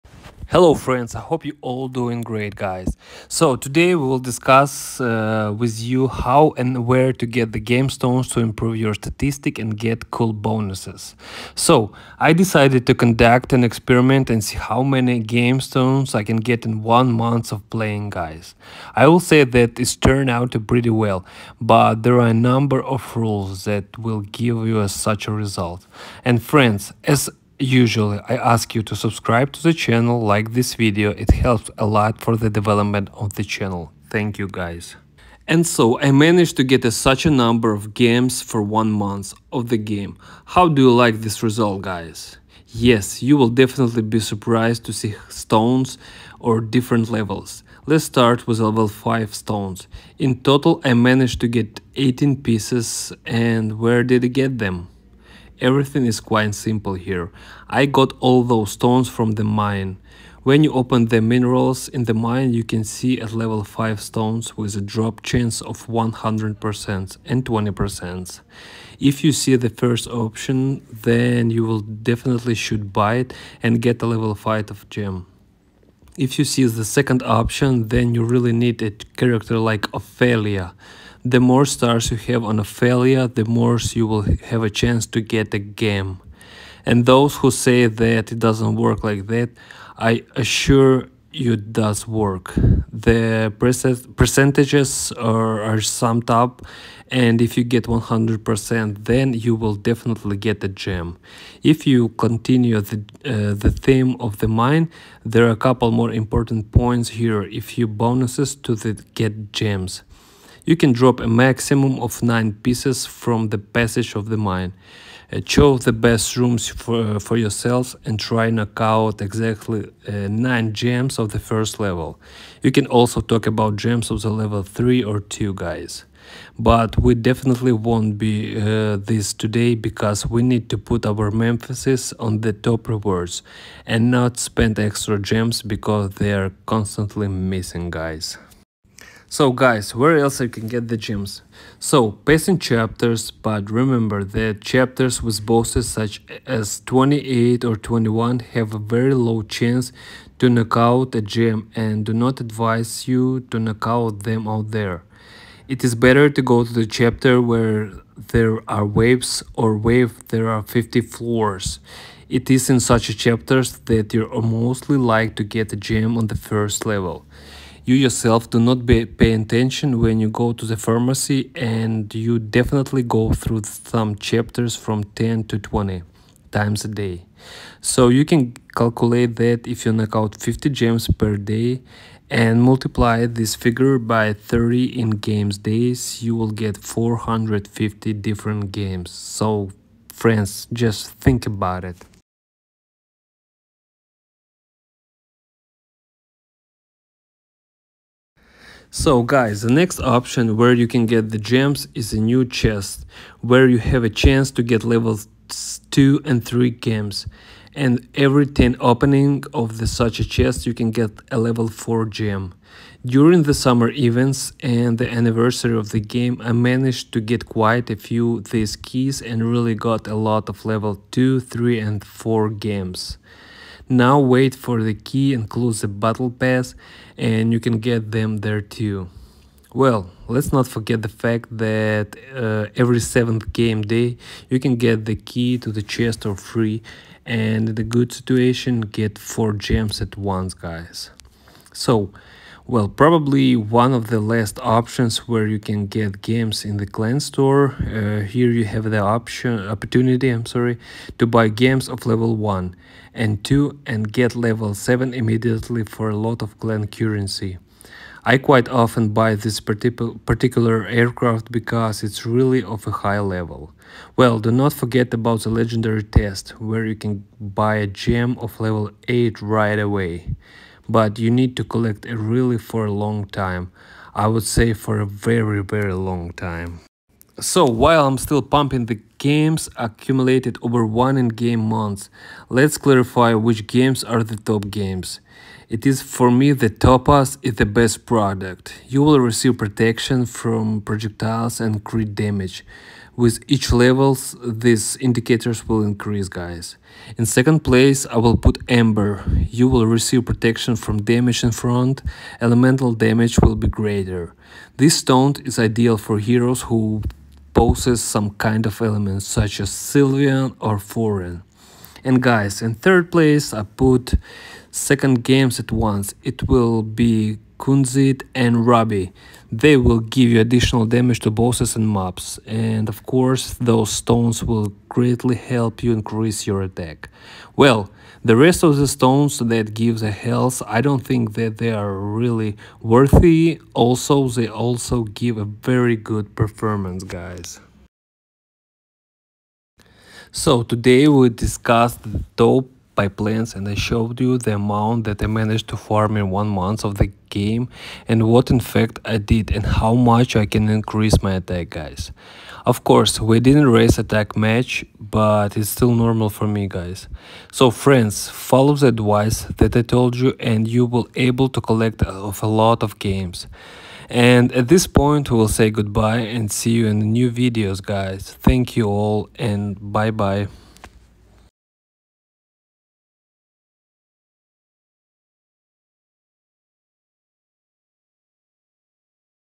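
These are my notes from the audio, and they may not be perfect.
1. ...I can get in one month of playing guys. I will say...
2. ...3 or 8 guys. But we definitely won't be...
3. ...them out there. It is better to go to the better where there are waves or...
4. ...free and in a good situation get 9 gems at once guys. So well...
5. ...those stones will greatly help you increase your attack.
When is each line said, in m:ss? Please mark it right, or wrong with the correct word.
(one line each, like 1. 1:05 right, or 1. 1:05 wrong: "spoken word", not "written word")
1. 0:16 right
2. 2:04 wrong: "2", not "8"
3. 2:34 wrong: "chapter", not "better"
4. 3:56 wrong: "4", not "9"
5. 5:23 right.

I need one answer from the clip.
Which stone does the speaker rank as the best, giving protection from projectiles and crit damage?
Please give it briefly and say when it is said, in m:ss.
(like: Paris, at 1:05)
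Topaz, at 4:46.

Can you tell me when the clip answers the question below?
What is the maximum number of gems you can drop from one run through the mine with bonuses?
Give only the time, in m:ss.
1:52.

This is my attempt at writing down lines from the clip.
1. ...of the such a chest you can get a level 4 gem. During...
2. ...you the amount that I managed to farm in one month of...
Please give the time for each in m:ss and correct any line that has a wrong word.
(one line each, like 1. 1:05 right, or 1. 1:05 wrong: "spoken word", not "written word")
1. 3:29 right
2. 5:44 right.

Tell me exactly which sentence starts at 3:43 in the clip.
Now wait for the key and close the battle pass and you can get them there too.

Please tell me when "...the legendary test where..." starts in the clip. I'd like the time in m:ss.
4:25.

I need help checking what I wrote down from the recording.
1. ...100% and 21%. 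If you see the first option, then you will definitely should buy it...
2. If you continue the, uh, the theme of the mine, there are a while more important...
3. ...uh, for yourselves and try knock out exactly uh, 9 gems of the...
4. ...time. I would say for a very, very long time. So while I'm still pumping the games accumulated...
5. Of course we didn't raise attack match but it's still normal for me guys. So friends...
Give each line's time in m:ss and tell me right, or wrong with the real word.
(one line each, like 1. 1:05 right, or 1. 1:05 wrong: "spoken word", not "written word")
1. 1:05 wrong: "20", not "21"
2. 1:41 wrong: "couple", not "while"
3. 1:57 right
4. 4:33 right
5. 5:52 right.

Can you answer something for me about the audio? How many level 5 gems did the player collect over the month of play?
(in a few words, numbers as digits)
18.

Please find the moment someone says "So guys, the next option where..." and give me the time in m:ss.
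3:18.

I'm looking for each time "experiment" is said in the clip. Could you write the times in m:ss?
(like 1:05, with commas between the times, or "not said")
0:13.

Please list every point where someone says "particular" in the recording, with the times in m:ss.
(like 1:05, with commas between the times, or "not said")
4:19.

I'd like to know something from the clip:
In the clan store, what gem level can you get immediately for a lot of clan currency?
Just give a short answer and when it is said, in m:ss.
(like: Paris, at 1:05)
Level 7, at 4:14.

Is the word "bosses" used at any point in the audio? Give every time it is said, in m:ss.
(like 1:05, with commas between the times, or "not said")
2:25, 5:21.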